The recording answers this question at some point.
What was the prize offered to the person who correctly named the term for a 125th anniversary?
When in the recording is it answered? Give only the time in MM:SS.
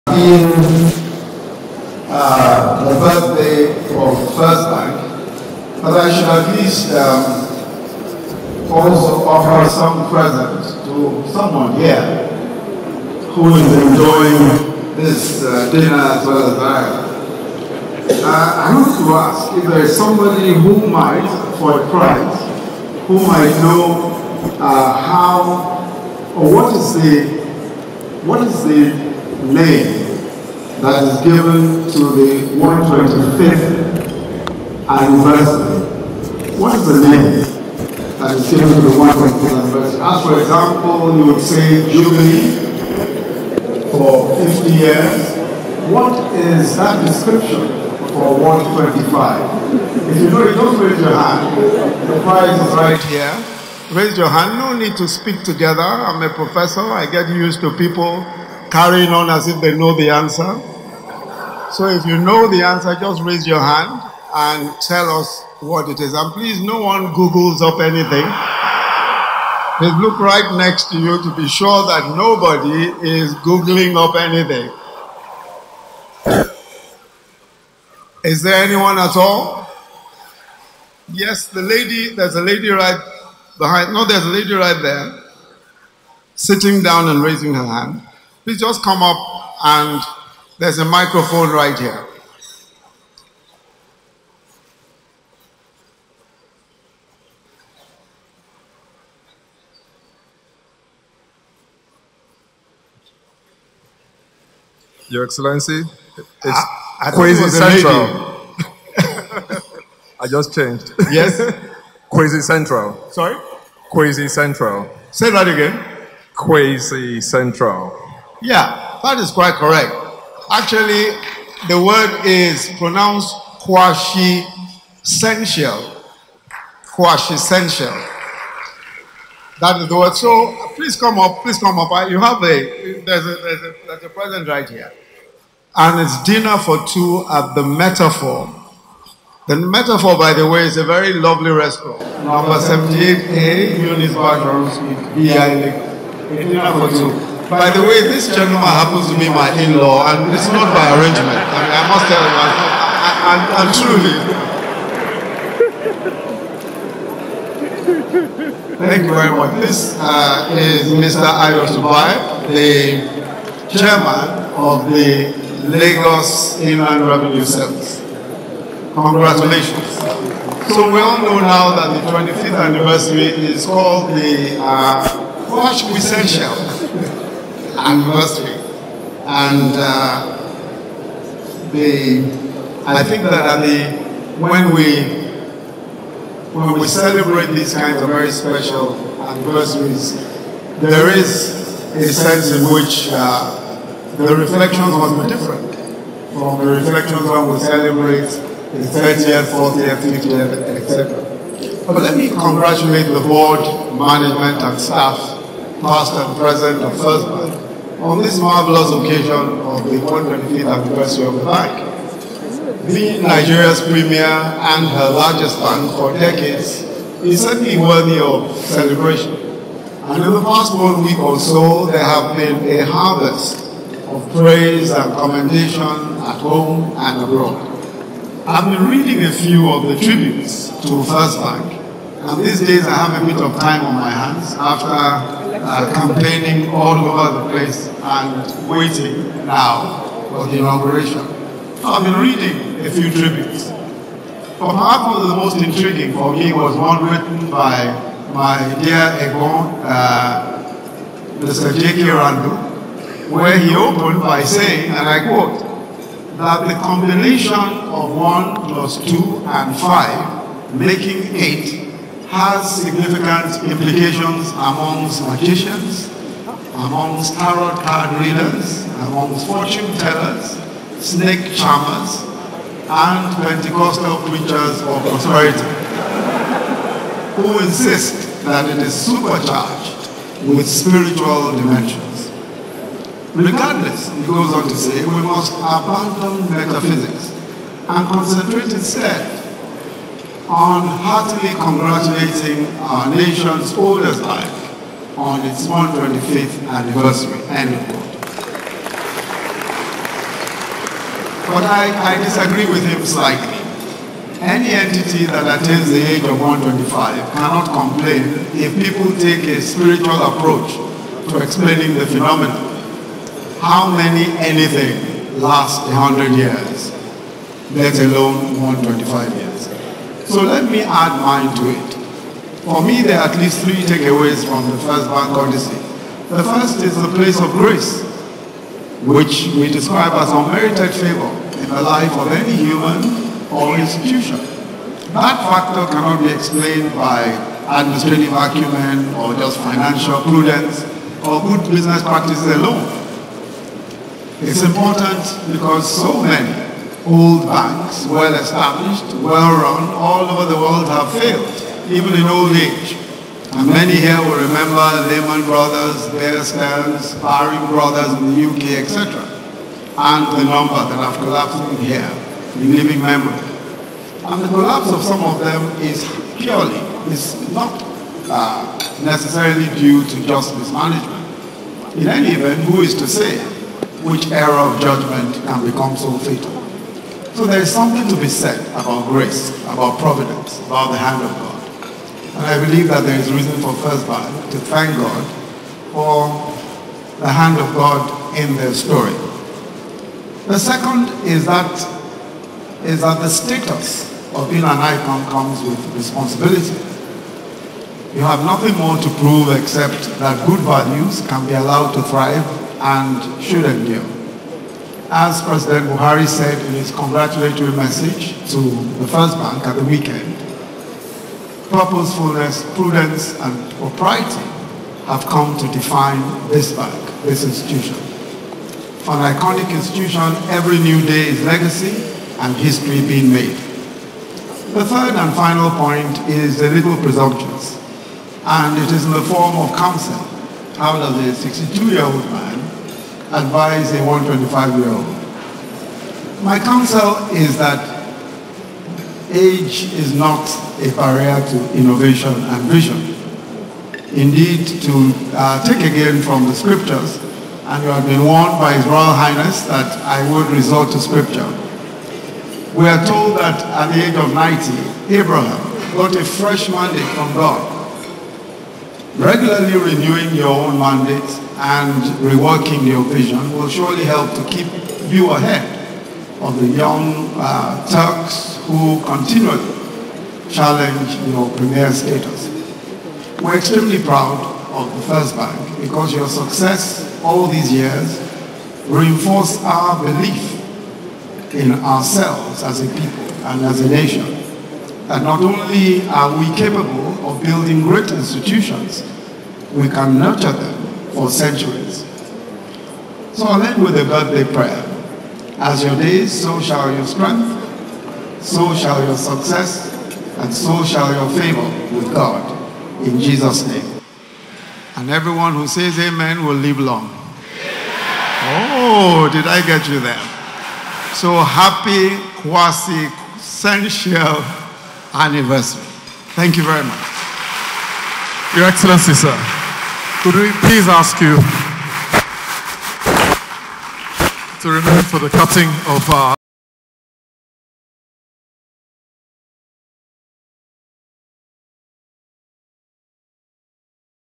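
02:16.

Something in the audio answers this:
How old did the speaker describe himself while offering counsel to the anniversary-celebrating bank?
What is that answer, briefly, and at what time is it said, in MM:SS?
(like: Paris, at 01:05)
62, at 07:11.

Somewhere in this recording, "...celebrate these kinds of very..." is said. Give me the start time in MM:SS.
03:06.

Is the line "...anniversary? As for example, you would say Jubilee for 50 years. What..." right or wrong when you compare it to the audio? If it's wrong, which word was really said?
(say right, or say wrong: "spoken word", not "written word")
right.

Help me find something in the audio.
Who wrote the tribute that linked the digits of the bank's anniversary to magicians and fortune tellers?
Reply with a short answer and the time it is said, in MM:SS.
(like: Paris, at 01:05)
J.K. Randall, at 04:11.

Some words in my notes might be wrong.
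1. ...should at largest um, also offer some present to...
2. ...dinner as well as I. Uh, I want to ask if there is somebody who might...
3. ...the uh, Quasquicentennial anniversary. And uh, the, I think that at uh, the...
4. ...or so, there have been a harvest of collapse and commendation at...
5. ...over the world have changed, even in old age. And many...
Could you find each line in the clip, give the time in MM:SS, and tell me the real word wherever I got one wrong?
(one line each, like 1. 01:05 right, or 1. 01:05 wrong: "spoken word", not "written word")
1. 00:06 wrong: "least", not "largest"
2. 00:15 right
3. 02:54 right
4. 03:41 wrong: "praise", not "collapse"
5. 05:50 wrong: "failed", not "changed".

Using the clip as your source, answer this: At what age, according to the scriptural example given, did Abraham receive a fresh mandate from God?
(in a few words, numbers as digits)
90.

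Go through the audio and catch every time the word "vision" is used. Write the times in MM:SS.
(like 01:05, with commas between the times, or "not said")
07:22, 07:43.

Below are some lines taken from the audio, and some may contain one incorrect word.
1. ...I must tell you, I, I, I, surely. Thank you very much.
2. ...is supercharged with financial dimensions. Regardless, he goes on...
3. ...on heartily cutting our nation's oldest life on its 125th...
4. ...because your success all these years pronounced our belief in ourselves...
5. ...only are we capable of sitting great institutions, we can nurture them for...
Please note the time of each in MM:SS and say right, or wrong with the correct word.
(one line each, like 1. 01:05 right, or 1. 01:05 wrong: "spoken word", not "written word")
1. 02:33 wrong: "truly", not "surely"
2. 04:38 wrong: "spiritual", not "financial"
3. 04:50 wrong: "congratulating", not "cutting"
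4. 07:55 wrong: "reinforced", not "pronounced"
5. 08:05 wrong: "building", not "sitting".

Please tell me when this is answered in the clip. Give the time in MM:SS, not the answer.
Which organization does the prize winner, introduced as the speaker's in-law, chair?
02:45.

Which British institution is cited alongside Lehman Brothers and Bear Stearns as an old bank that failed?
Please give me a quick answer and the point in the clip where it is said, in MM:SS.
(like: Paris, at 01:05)
Baring Brothers, at 05:57.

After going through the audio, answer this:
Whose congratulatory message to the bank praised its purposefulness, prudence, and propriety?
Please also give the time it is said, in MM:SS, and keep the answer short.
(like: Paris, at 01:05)
President Buhari, at 06:45.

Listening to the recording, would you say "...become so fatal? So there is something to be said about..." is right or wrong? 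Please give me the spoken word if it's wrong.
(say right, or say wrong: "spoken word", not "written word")
right.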